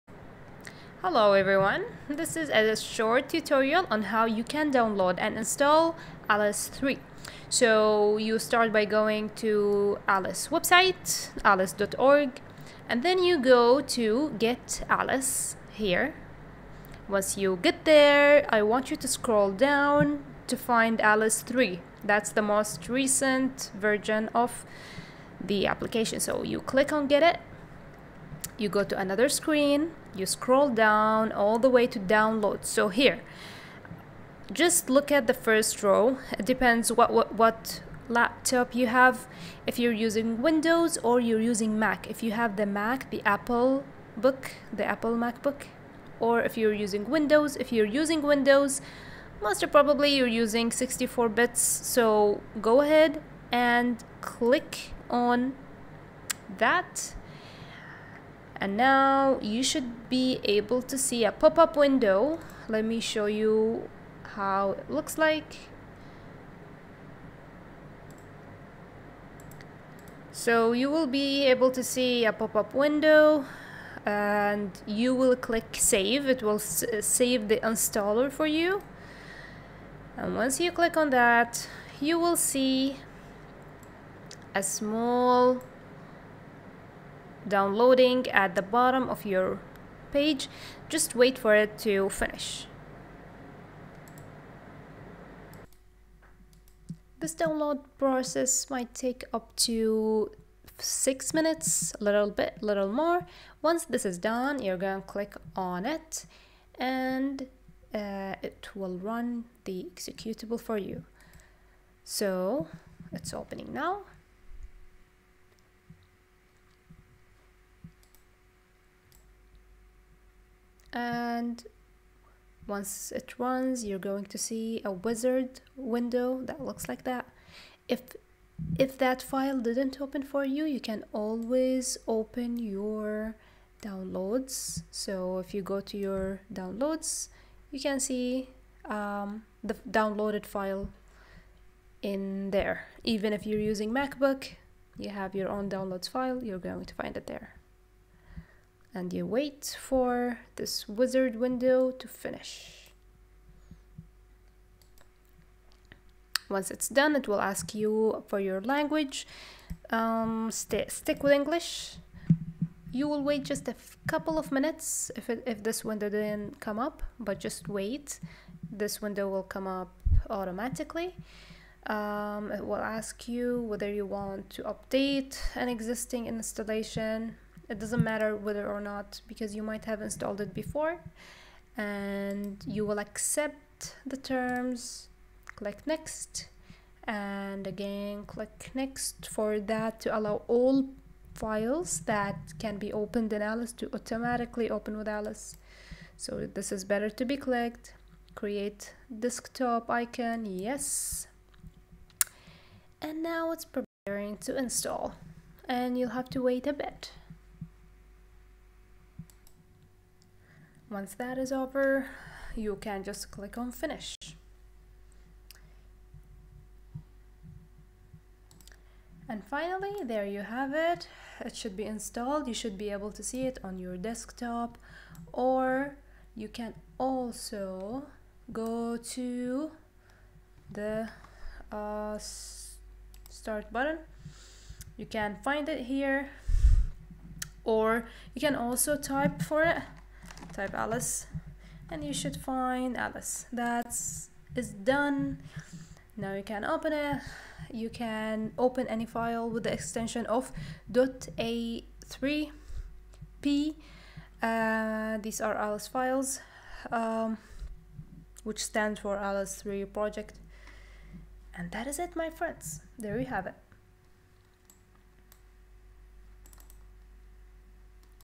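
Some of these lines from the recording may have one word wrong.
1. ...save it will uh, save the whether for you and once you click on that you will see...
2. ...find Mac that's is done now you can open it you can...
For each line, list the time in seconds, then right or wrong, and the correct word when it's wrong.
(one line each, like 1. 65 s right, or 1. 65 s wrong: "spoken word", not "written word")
1. 75 s wrong: "installer", not "whether"
2. 242 s wrong: "Alice", not "Mac".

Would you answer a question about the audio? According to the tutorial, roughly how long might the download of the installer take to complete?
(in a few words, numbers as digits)
6 minutes.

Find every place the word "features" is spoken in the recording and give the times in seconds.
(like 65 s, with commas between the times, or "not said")
not said.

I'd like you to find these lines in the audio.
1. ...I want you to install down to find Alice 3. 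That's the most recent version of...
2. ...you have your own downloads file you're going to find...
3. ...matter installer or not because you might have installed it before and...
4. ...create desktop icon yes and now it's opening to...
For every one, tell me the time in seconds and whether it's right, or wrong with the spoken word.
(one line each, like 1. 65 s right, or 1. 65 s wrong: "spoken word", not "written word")
1. 18 s wrong: "scroll", not "install"
2. 144 s right
3. 178 s wrong: "whether", not "installer"
4. 198 s wrong: "preparing", not "opening".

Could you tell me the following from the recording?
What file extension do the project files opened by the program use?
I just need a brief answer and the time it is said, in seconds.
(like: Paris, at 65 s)
.a3p, at 250 s.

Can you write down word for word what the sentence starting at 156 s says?
Once it's done, it will ask you for your language.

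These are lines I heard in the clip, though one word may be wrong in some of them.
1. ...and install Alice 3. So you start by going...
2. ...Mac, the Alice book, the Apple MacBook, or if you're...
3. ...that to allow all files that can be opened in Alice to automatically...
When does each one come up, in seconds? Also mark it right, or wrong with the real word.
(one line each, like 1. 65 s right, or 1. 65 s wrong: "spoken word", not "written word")
1. 5 s right
2. 42 s wrong: "Apple", not "Alice"
3. 189 s right.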